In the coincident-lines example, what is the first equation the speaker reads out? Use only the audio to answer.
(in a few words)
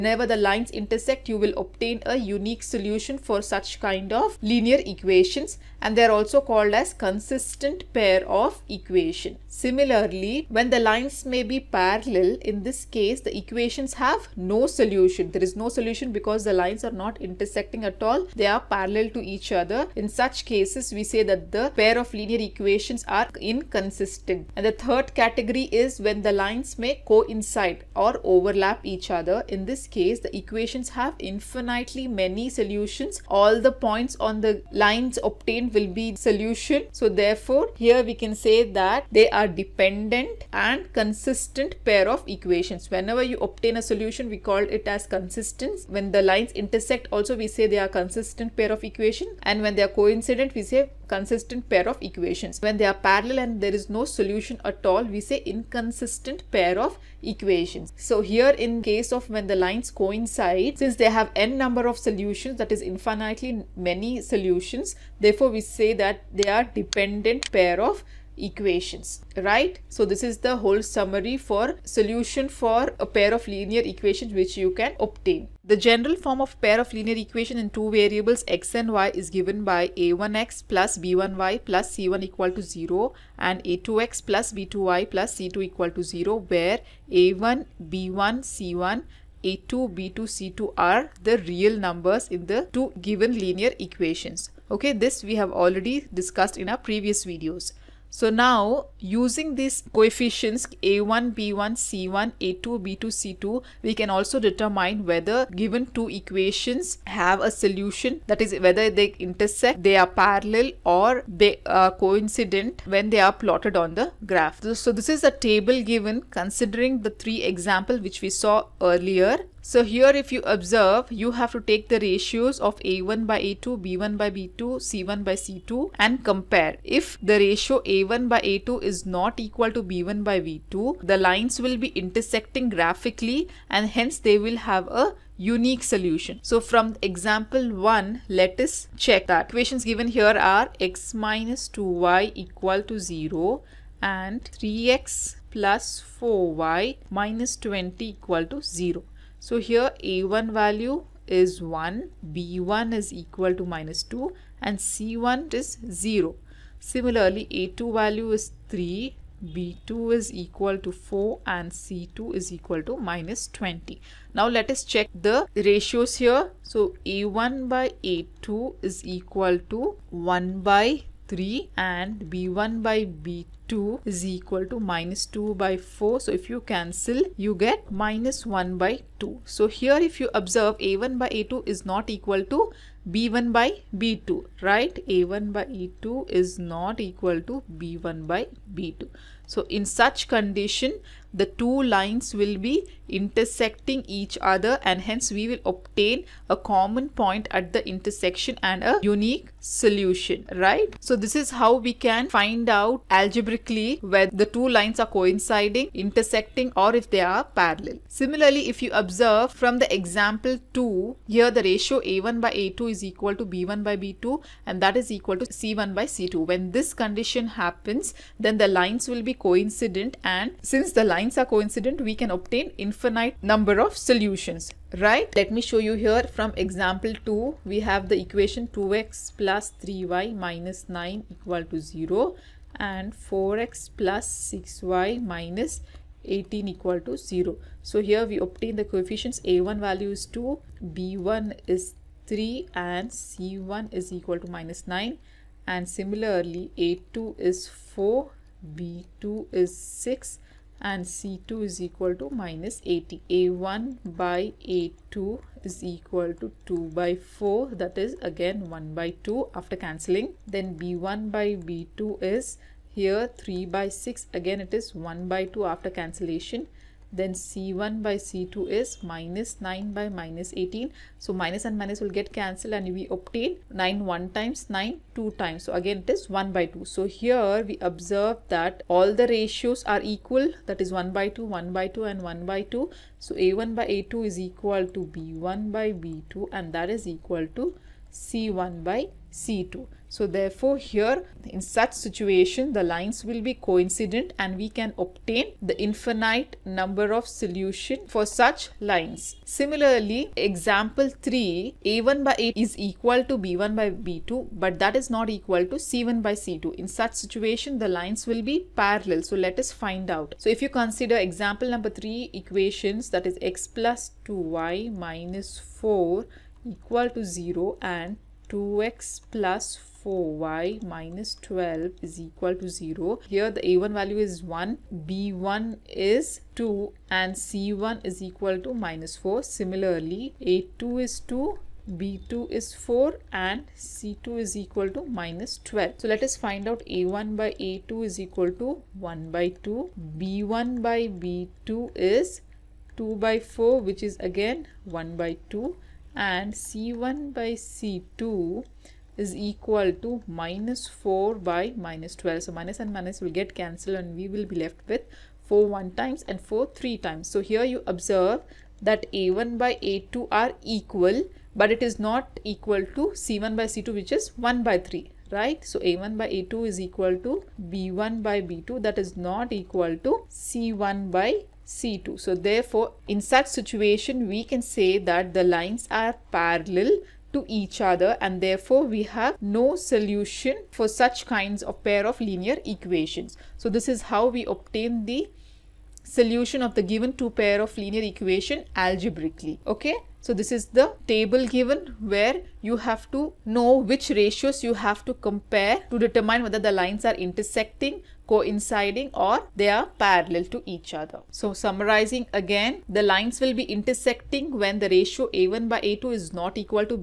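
2x + 3y - 9 = 0.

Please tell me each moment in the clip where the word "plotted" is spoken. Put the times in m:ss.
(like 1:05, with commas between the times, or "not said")
1:53.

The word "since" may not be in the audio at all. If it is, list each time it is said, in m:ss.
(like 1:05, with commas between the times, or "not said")
1:00, 3:40.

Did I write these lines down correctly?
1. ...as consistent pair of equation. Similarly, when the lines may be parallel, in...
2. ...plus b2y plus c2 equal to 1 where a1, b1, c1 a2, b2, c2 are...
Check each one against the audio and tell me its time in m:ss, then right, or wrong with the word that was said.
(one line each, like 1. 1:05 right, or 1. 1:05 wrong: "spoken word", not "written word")
1. 0:06 right
2. 1:24 wrong: "0", not "1".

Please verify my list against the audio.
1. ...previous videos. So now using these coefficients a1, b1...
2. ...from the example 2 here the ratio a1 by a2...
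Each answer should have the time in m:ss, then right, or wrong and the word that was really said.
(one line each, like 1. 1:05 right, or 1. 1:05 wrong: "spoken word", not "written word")
1. 1:36 right
2. 3:29 right.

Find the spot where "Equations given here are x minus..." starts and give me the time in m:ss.
2:19.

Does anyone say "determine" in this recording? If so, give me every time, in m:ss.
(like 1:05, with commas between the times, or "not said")
1:44, 6:35.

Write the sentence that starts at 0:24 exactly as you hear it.
And the third category is when the lines may coincide or overlap each other.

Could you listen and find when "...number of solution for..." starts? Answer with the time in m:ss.
4:56.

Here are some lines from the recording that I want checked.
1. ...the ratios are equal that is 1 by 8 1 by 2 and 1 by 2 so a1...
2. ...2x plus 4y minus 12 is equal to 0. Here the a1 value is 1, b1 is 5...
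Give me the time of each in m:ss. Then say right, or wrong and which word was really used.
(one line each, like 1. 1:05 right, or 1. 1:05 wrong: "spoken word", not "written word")
1. 4:39 wrong: "2", not "8"
2. 5:18 wrong: "2", not "5".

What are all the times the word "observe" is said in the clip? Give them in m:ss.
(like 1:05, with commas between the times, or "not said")
2:00, 3:00, 3:28, 4:37, 5:57.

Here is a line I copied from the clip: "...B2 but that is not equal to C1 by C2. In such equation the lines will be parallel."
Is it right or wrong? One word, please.
wrong.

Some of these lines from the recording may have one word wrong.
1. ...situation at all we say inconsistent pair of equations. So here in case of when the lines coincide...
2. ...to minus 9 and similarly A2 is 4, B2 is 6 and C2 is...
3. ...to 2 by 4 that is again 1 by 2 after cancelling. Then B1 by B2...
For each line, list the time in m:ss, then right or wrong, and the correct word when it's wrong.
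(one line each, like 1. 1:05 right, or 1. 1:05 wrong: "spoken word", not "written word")
1. 0:54 wrong: "solution", not "situation"
2. 4:04 right
3. 4:16 right.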